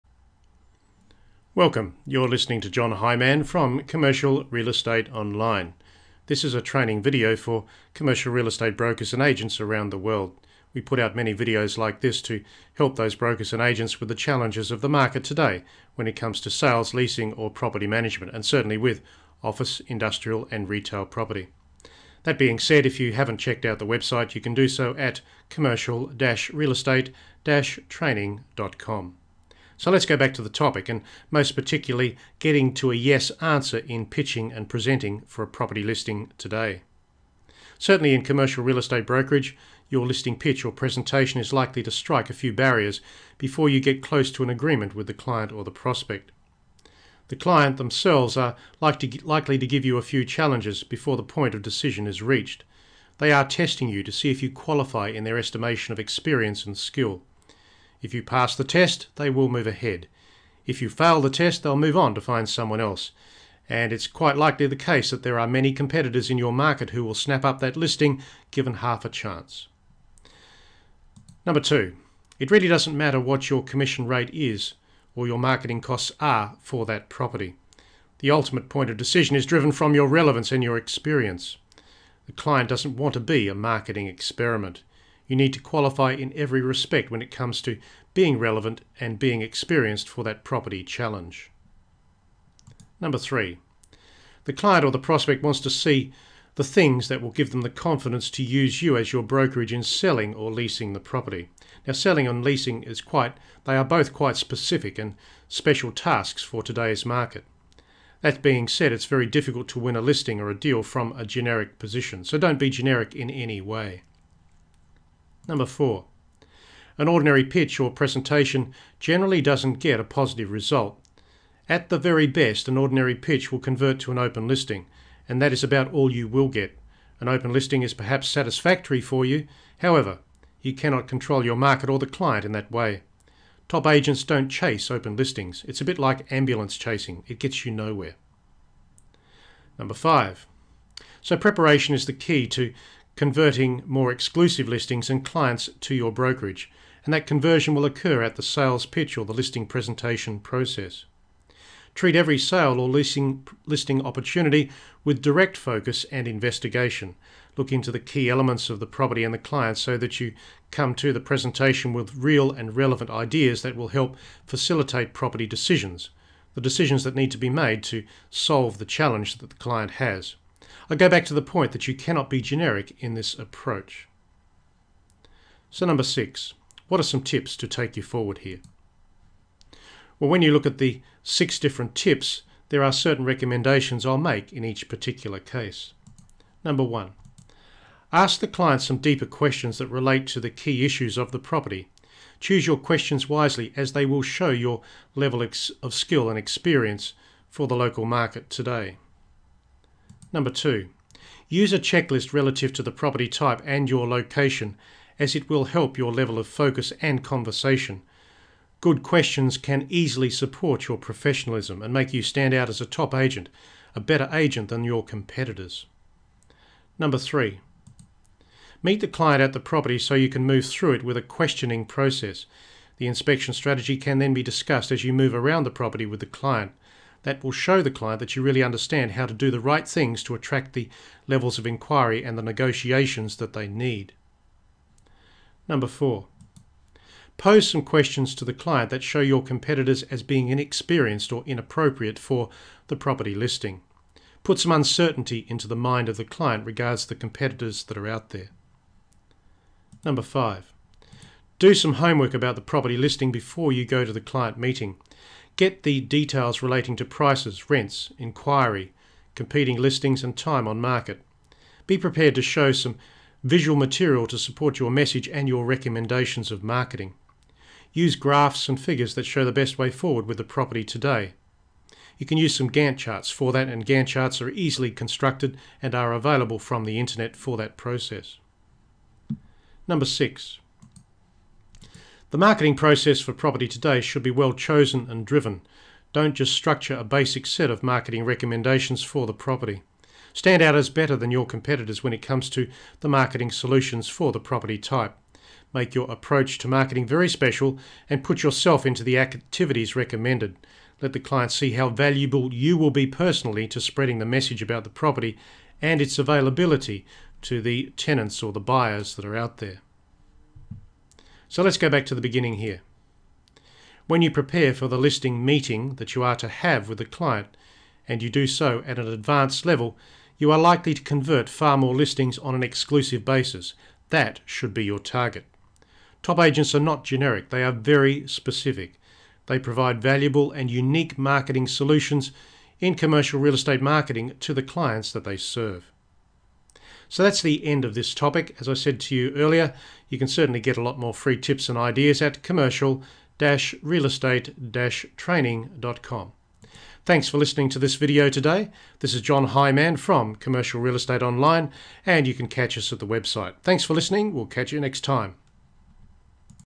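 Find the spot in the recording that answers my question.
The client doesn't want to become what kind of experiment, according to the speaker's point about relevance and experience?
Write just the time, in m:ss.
1:23.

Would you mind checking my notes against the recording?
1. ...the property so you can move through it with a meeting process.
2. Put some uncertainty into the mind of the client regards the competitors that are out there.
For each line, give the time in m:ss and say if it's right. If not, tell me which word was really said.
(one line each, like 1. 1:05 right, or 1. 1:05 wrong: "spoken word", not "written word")
1. 3:39 wrong: "questioning", not "meeting"
2. 4:04 right.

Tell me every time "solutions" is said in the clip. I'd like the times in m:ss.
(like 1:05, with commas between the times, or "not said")
4:53, 5:31.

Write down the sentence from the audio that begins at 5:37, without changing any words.
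So that's the end of this topic.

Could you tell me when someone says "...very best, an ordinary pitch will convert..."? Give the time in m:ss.
2:01.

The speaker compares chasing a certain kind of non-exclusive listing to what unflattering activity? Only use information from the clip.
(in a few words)
Ambulance chasing.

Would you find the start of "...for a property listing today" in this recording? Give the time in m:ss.
0:35.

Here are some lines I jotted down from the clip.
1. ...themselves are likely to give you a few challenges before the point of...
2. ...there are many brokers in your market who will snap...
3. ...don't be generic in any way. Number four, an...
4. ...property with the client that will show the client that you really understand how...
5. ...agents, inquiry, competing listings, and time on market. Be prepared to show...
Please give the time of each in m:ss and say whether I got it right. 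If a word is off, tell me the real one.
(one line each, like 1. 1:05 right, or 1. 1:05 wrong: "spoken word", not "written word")
1. 0:47 right
2. 1:05 wrong: "competitors", not "brokers"
3. 1:52 right
4. 3:45 right
5. 4:17 wrong: "rents", not "agents".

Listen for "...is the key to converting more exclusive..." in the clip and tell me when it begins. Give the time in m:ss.
2:21.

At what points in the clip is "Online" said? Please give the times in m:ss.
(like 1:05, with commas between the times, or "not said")
0:05, 5:51.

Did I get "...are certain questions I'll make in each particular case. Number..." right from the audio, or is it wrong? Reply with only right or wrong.
wrong.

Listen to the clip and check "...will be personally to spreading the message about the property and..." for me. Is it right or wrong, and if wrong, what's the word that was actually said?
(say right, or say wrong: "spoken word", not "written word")
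right.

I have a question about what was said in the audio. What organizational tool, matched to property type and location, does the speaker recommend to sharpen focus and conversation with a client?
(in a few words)
A checklist.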